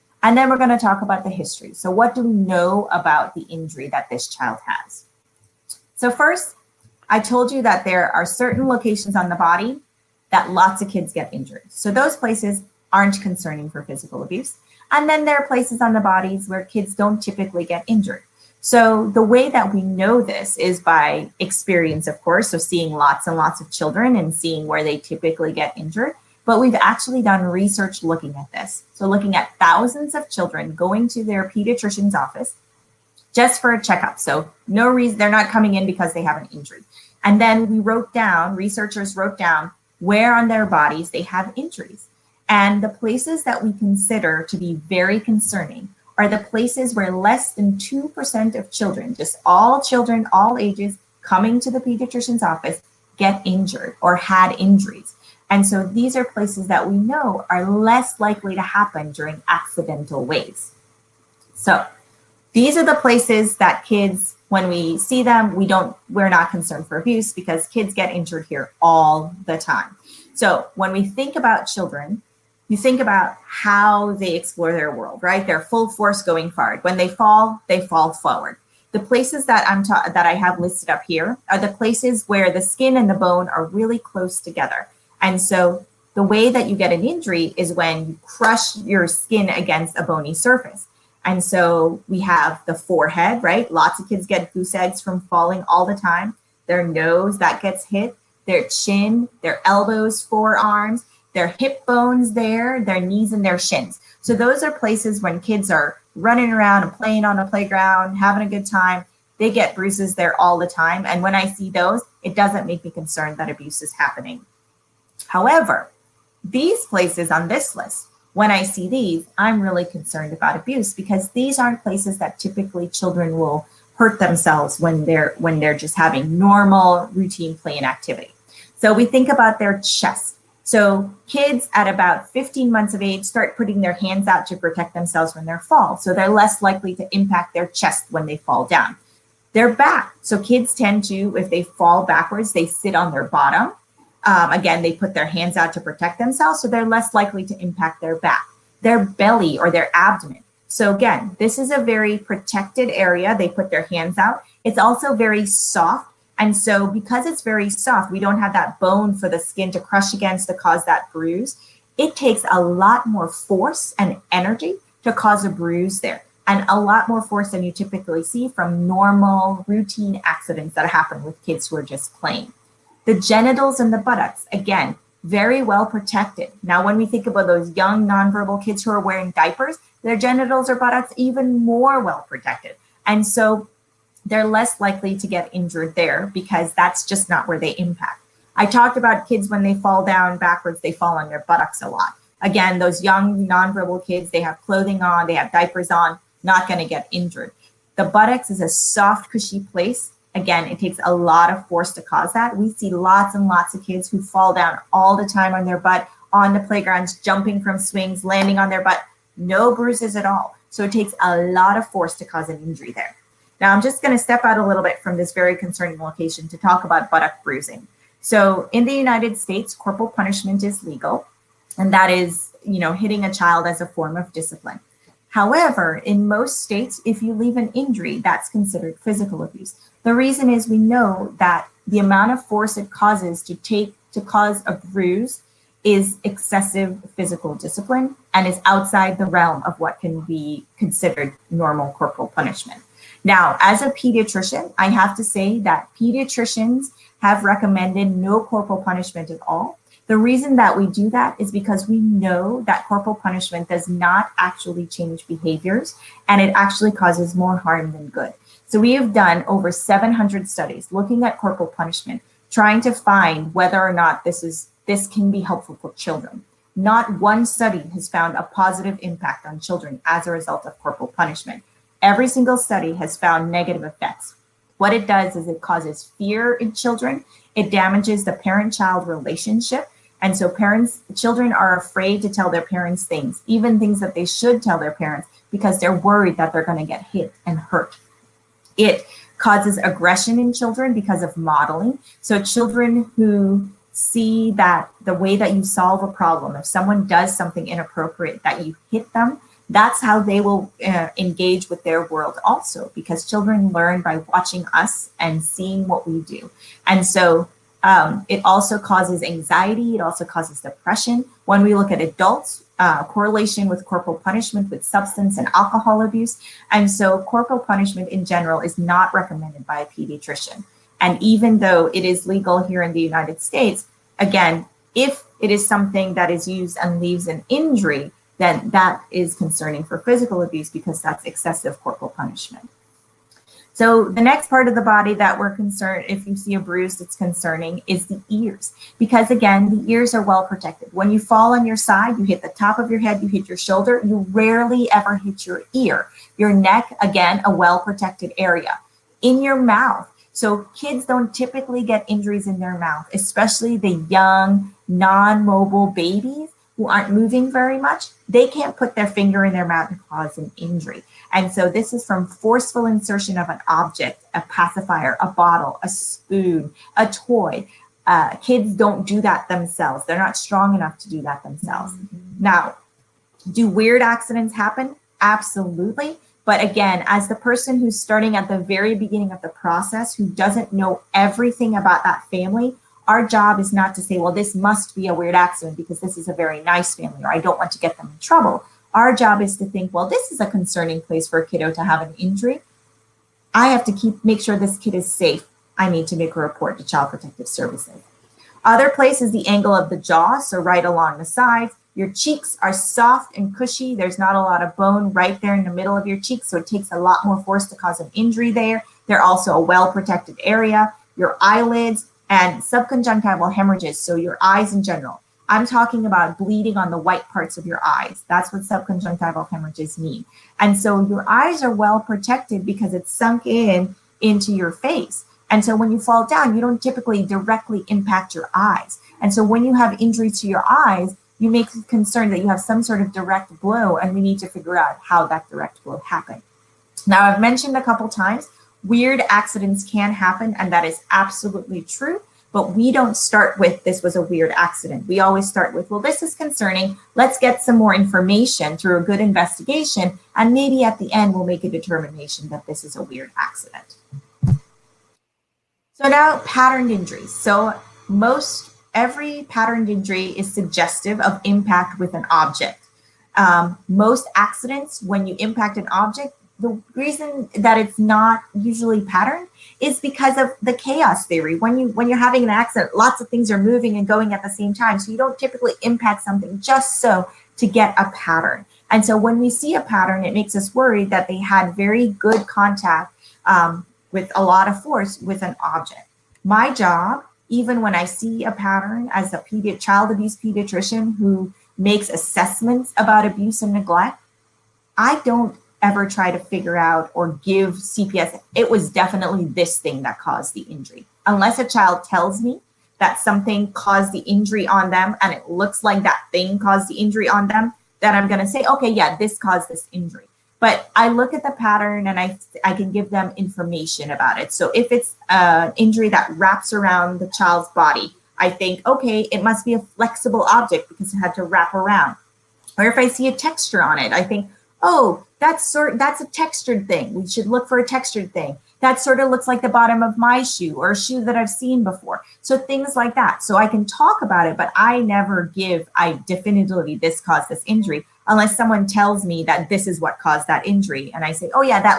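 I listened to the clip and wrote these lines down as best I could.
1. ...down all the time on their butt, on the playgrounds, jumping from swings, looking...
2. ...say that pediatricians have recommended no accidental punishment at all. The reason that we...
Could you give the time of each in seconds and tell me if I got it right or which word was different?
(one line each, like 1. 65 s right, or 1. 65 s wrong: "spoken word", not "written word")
1. 204 s wrong: "landing", not "looking"
2. 245 s wrong: "corporal", not "accidental".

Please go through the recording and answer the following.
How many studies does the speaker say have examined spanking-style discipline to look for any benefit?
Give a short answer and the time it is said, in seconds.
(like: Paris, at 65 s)
over 700, at 259 s.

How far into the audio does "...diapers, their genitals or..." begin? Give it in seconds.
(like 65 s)
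179 s.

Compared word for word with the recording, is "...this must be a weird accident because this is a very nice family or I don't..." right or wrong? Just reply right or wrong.
right.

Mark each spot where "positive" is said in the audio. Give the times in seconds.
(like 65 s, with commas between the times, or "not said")
268 s.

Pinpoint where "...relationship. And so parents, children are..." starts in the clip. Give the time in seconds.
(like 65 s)
279 s.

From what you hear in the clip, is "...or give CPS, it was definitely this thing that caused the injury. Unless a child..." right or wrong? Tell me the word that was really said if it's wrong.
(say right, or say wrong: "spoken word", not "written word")
right.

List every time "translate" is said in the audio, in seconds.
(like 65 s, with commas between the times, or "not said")
not said.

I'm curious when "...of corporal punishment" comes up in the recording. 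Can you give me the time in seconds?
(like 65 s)
270 s.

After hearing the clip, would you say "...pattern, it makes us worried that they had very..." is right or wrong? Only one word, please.
right.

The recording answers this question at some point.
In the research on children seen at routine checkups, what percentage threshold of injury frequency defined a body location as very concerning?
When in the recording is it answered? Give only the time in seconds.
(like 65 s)
47 s.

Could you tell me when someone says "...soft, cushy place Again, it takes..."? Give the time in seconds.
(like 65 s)
198 s.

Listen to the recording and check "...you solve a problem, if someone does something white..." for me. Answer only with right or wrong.
wrong.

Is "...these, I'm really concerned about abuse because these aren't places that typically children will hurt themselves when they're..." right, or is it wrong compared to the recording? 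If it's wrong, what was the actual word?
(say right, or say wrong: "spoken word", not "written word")
right.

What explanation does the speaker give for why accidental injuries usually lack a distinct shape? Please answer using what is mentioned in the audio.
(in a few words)
Chaos theory.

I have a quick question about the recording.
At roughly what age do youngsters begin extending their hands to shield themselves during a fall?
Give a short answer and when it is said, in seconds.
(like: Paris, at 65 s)
15 months, at 132 s.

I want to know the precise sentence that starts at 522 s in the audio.
Or if I see a texture on it, I think, oh, that's sort that's a textured thing.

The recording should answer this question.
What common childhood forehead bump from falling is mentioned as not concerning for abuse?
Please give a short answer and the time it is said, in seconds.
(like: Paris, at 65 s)
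Goose eggs, at 94 s.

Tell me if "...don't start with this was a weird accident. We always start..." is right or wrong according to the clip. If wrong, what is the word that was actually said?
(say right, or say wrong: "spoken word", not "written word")
right.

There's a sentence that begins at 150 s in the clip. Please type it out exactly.
So, again, this is a very protected area.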